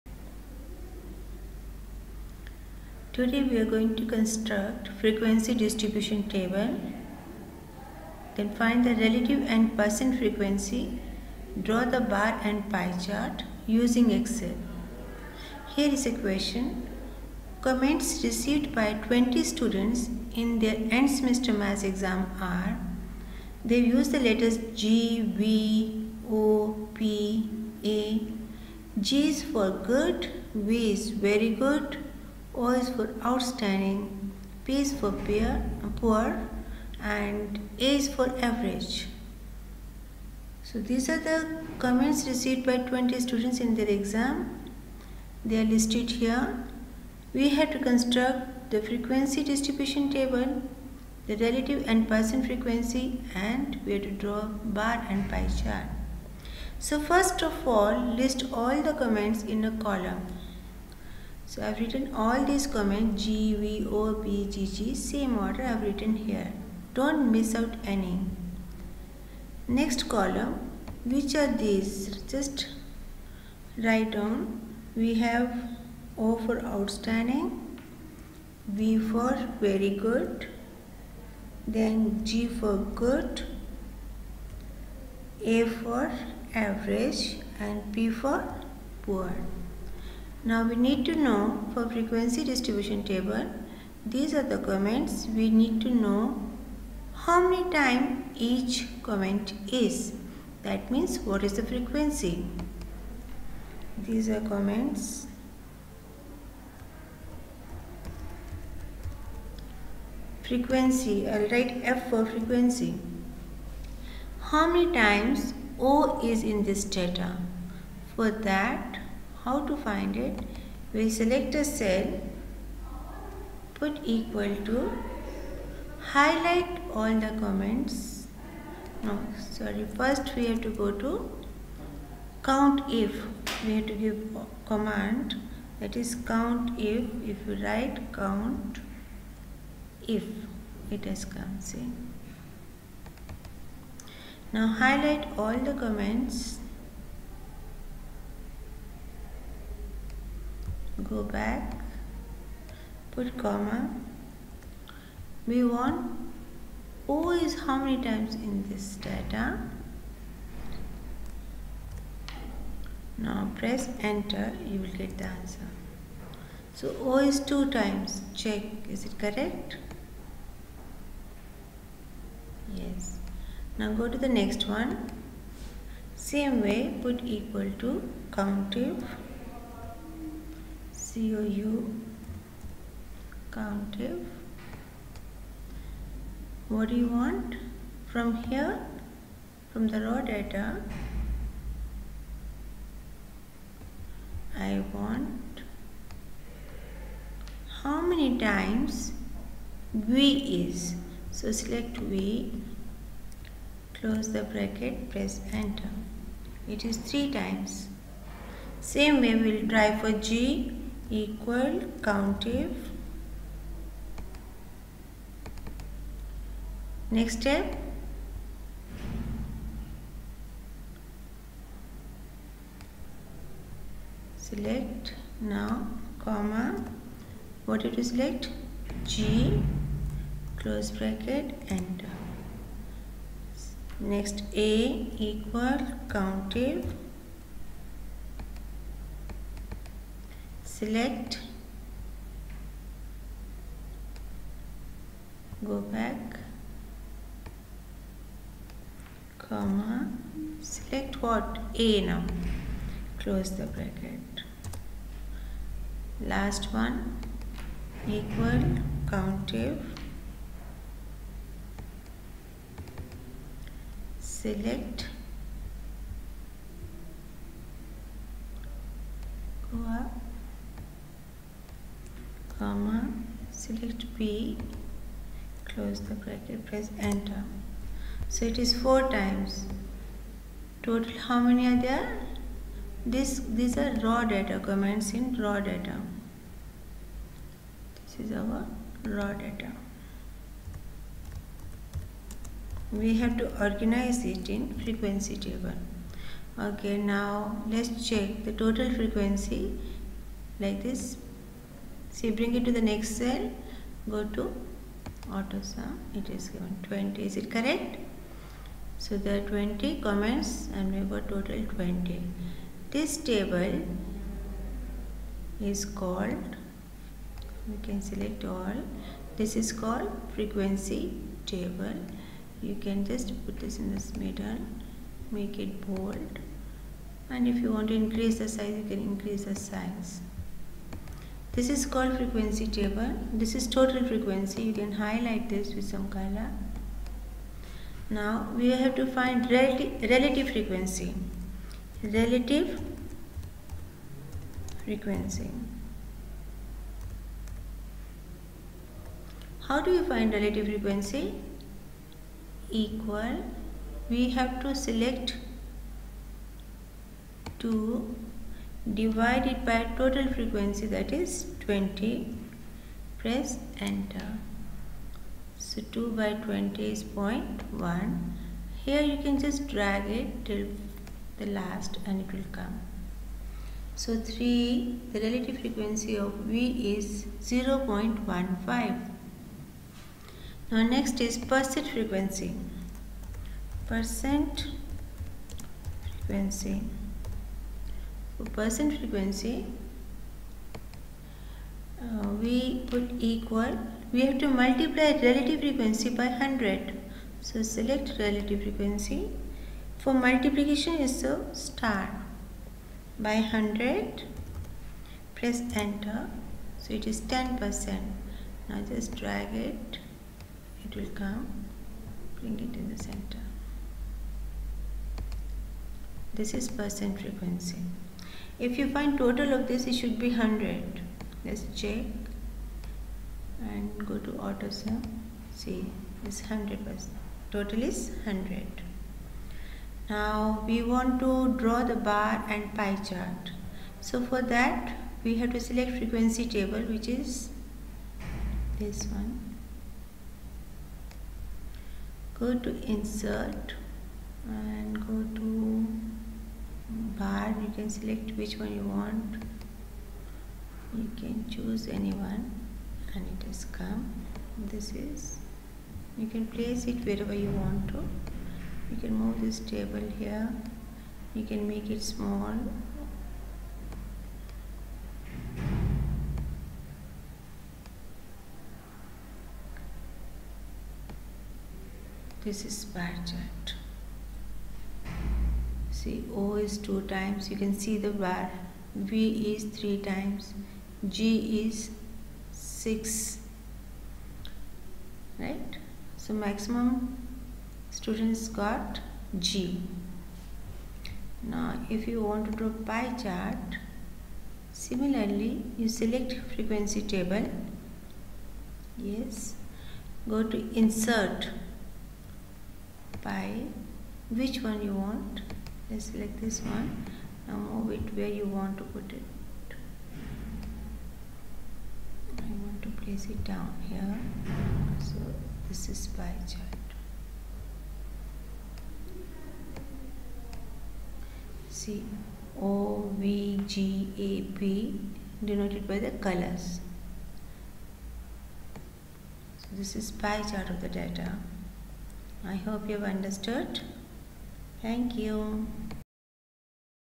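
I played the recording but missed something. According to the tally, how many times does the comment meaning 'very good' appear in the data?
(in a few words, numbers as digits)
3.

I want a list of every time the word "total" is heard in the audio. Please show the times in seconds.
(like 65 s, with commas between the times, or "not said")
280 s, 298 s, 311 s, 333 s, 359 s, 419 s, 427 s.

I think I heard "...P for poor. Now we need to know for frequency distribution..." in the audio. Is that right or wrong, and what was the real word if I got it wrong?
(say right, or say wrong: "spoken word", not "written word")
right.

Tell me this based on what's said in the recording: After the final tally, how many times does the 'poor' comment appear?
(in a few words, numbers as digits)
4.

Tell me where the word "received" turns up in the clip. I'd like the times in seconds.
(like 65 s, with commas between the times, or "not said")
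18 s, 42 s.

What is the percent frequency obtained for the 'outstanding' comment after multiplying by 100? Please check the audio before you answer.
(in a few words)
10 percent.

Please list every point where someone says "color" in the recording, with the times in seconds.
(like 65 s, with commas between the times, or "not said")
336 s, 526 s.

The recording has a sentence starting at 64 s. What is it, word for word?
same order I have written here.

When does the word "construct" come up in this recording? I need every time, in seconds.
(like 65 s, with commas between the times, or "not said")
4 s, 47 s.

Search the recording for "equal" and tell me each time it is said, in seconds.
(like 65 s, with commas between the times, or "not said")
124 s, 177 s, 211 s, 235 s, 258 s, 352 s, 393 s.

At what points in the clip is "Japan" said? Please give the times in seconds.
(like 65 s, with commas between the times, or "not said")
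not said.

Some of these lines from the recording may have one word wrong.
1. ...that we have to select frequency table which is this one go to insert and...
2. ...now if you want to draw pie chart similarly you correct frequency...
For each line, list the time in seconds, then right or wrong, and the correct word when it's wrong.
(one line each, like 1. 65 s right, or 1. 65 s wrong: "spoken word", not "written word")
1. 434 s right
2. 491 s wrong: "select", not "correct".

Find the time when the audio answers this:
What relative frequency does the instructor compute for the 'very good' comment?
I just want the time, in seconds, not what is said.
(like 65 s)
377 s.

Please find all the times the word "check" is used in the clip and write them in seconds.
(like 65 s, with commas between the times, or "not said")
168 s, 298 s, 421 s.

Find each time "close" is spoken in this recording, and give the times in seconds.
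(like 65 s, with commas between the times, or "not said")
203 s, 230 s, 253 s, 275 s.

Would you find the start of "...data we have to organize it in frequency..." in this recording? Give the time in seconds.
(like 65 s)
289 s.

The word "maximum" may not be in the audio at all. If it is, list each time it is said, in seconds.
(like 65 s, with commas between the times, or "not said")
486 s.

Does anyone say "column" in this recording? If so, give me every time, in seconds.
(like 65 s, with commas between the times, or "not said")
59 s, 70 s.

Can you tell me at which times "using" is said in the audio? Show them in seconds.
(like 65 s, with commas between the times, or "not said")
13 s.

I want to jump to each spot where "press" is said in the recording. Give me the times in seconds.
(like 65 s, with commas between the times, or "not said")
163 s, 205 s, 276 s, 363 s, 405 s.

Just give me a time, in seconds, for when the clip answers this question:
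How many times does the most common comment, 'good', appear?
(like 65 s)
481 s.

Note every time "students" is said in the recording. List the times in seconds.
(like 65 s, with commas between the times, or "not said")
19 s, 43 s, 487 s.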